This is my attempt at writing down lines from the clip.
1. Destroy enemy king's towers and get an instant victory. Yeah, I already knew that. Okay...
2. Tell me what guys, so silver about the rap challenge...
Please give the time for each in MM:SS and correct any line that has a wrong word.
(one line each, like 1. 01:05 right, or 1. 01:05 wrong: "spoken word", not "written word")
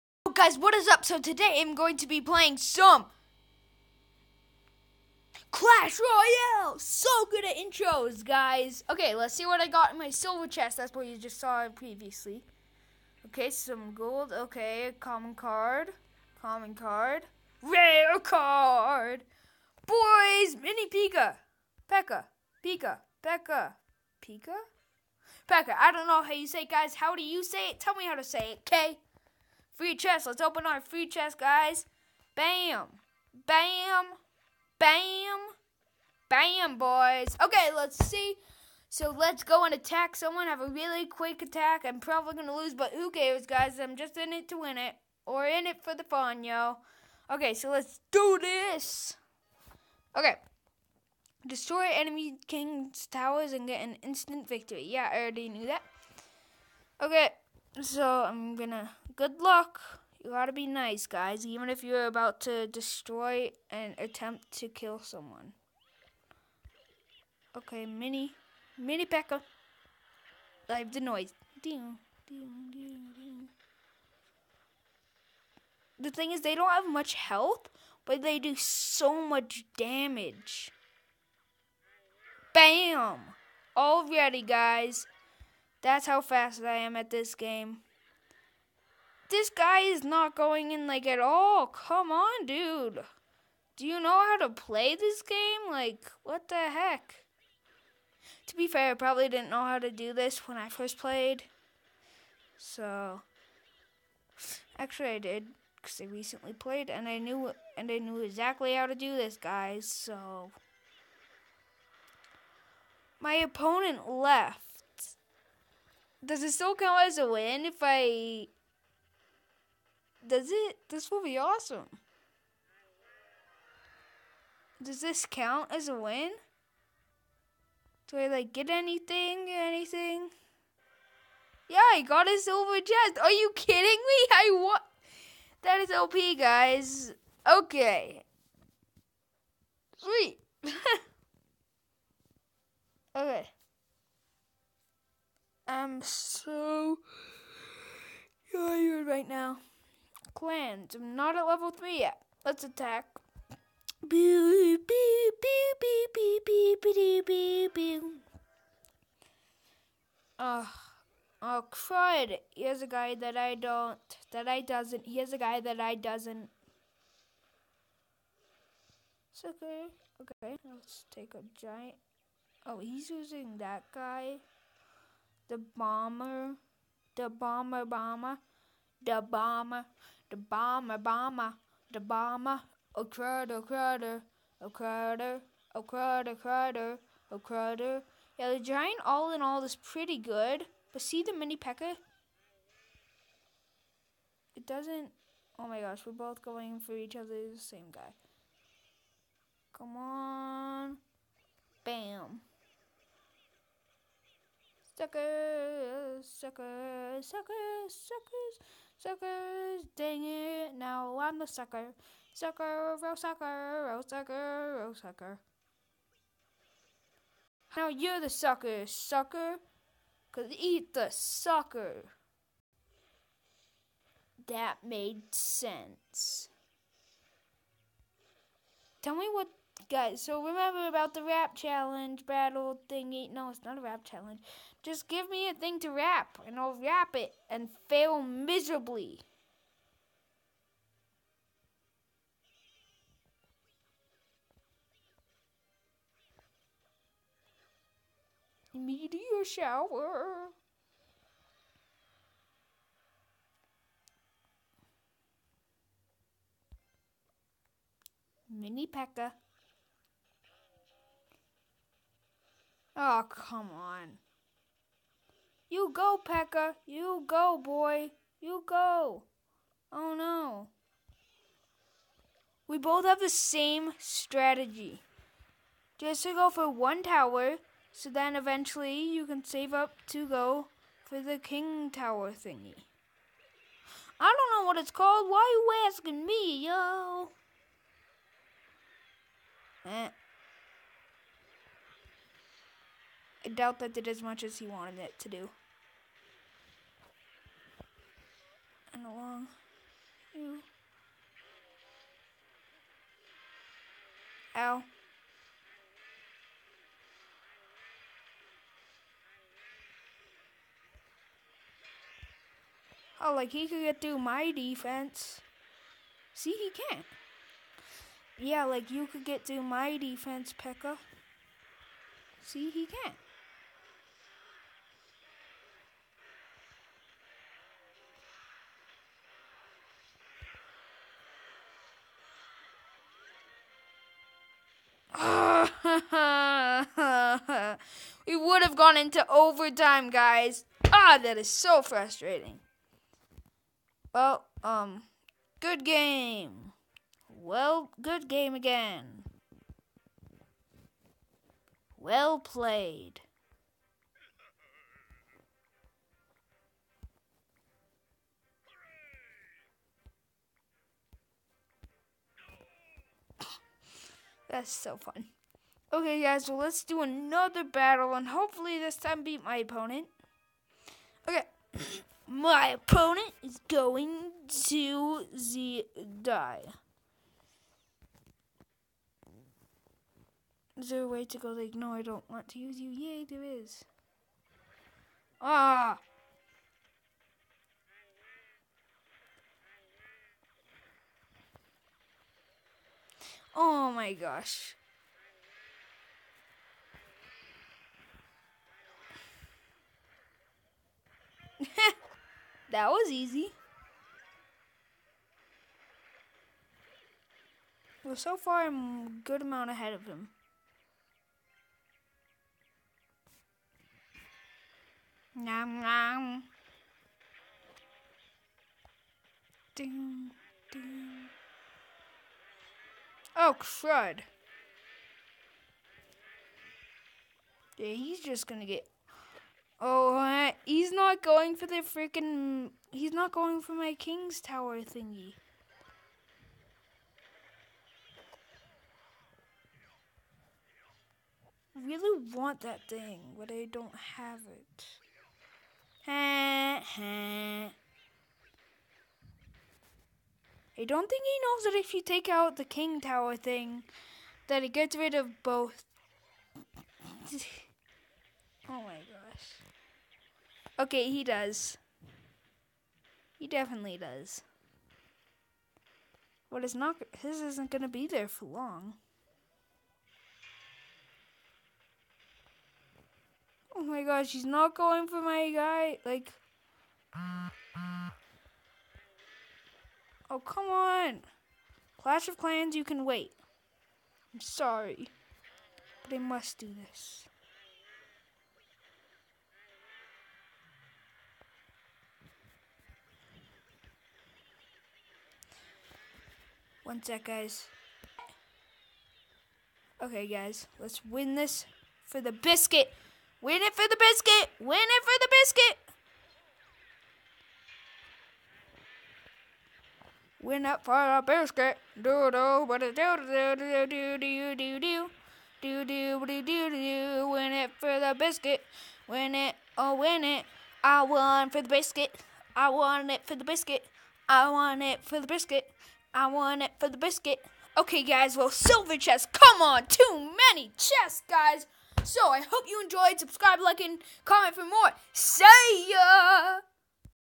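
1. 00:51 right
2. 03:49 wrong: "remember", not "silver".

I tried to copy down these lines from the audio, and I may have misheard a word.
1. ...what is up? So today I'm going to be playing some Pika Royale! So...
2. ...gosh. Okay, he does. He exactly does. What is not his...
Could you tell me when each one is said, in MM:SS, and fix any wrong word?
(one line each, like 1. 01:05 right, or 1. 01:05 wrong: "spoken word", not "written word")
1. 00:00 wrong: "Clash", not "Pika"
2. 07:39 wrong: "definitely", not "exactly".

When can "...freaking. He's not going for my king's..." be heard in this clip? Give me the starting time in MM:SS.
07:11.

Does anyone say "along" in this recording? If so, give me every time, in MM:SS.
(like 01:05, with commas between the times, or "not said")
04:59.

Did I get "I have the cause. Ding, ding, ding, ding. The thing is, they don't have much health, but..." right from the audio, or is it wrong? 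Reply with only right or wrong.
wrong.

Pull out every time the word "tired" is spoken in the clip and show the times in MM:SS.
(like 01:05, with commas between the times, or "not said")
02:28.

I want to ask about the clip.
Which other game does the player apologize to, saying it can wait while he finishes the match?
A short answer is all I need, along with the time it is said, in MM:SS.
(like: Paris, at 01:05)
Clash of Clans, at 08:02.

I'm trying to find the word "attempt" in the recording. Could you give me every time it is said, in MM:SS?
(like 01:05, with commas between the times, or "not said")
01:03.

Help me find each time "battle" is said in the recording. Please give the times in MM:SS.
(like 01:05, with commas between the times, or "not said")
03:52, 06:07.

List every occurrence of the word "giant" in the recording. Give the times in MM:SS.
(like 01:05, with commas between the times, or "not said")
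02:51, 03:08.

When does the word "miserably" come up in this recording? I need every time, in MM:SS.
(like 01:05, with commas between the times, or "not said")
03:58.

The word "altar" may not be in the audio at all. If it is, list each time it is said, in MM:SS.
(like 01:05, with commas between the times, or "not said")
not said.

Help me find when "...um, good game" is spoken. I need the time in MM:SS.
05:44.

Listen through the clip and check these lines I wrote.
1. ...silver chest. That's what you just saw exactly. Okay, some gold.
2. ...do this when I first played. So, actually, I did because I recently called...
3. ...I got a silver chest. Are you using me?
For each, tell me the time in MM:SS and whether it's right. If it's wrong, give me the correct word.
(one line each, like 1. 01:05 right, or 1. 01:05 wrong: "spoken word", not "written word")
1. 00:10 wrong: "previously", not "exactly"
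2. 01:39 wrong: "played", not "called"
3. 02:11 wrong: "kidding", not "using".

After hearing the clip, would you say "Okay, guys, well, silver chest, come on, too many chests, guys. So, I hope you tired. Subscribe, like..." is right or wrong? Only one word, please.
wrong.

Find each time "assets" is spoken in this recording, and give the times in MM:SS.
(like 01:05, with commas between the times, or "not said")
not said.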